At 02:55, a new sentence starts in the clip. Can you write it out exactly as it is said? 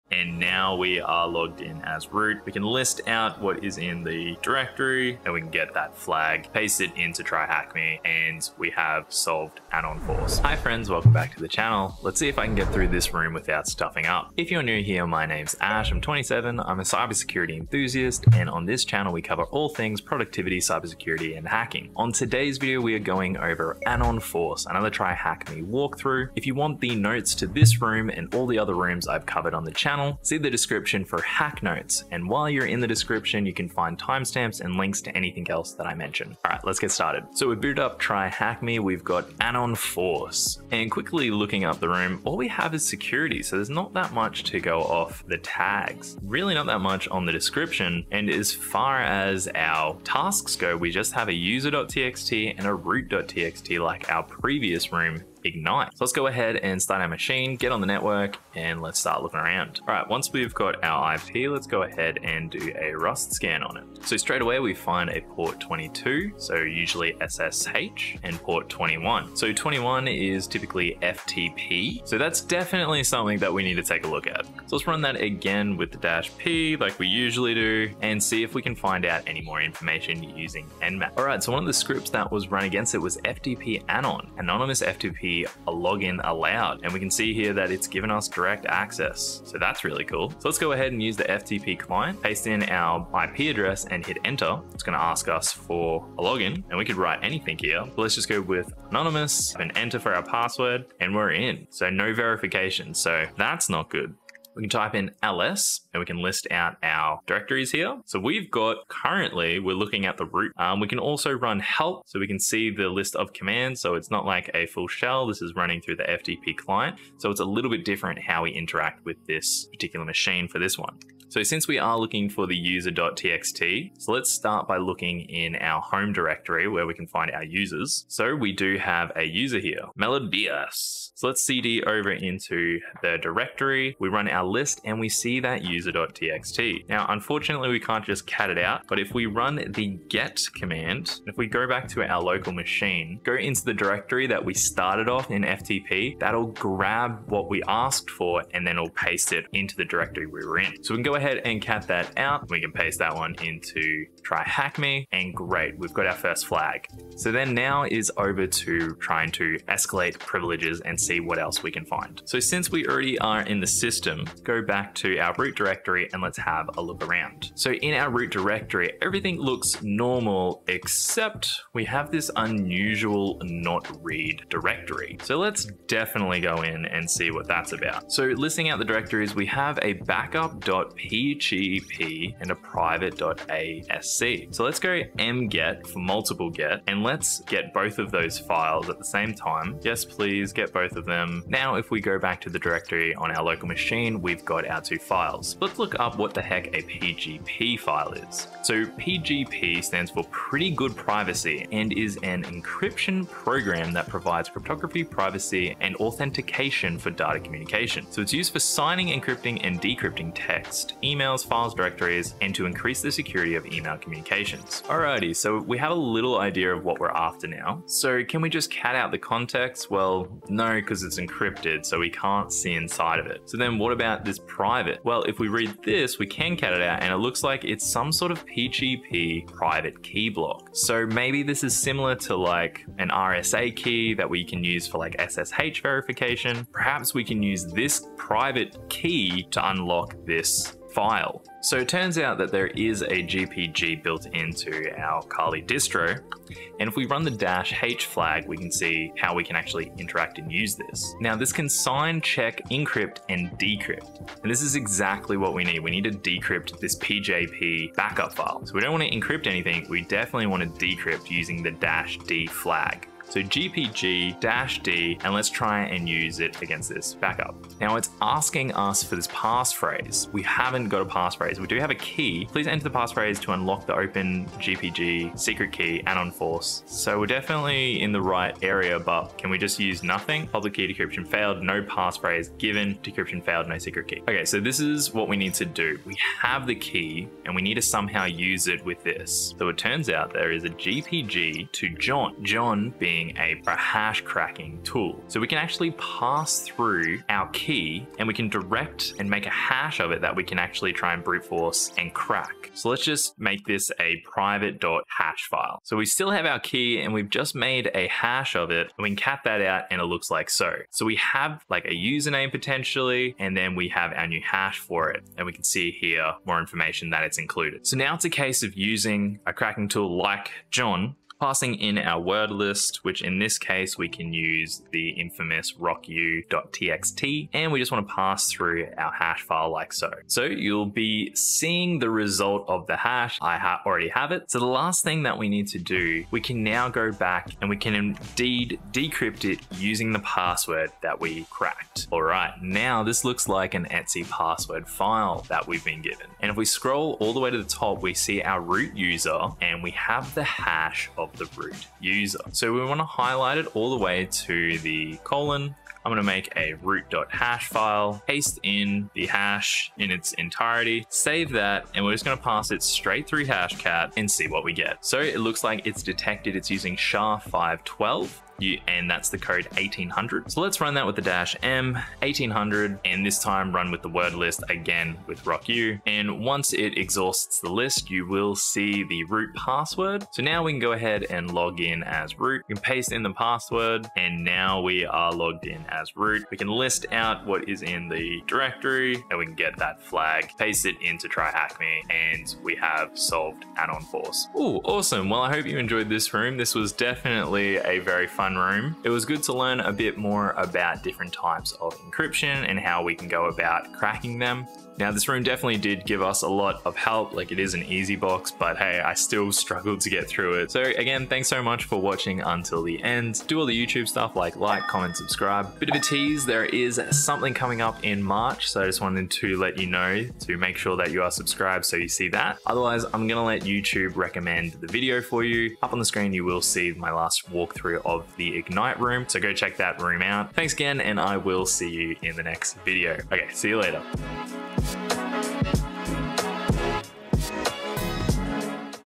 So let's definitely go in and see what that's about.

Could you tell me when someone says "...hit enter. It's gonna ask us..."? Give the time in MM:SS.
01:34.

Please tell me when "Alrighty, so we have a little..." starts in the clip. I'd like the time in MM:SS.
03:34.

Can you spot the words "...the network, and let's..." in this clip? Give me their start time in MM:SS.
00:57.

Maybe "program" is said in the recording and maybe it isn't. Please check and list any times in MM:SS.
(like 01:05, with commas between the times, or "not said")
03:23.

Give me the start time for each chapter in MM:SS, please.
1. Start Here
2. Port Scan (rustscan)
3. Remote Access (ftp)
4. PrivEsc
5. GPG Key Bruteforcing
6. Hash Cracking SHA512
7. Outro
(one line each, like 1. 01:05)
1. 00:37
2. 00:59
3. 01:30
4. 02:42
5. 04:44
6. 05:42
7. 06:34.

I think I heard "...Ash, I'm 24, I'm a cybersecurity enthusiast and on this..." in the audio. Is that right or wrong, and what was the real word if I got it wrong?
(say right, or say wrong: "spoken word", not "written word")
wrong: "27", not "24".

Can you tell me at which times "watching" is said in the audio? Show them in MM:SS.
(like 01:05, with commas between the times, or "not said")
06:51.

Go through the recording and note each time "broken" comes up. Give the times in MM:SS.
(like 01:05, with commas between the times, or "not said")
not said.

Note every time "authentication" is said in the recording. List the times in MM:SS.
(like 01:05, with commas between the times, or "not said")
03:25.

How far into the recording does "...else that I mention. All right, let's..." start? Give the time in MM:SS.
00:35.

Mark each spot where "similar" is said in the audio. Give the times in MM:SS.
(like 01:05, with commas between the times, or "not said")
03:51.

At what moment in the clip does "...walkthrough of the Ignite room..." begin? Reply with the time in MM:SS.
07:07.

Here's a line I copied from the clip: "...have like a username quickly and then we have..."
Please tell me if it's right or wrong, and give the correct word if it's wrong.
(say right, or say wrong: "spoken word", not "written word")
wrong: "potentially", not "quickly".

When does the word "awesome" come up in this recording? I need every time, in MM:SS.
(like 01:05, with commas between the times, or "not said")
06:34.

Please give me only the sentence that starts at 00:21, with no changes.
On today's video we are going over anon force, another TryHackMe walkthrough.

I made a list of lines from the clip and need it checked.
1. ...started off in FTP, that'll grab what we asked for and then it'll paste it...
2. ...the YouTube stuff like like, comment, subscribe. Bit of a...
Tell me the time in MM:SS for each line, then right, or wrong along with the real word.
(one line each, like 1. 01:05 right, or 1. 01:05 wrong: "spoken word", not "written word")
1. 02:24 right
2. 06:53 right.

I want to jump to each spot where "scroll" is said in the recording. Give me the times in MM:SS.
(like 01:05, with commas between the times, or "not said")
05:46.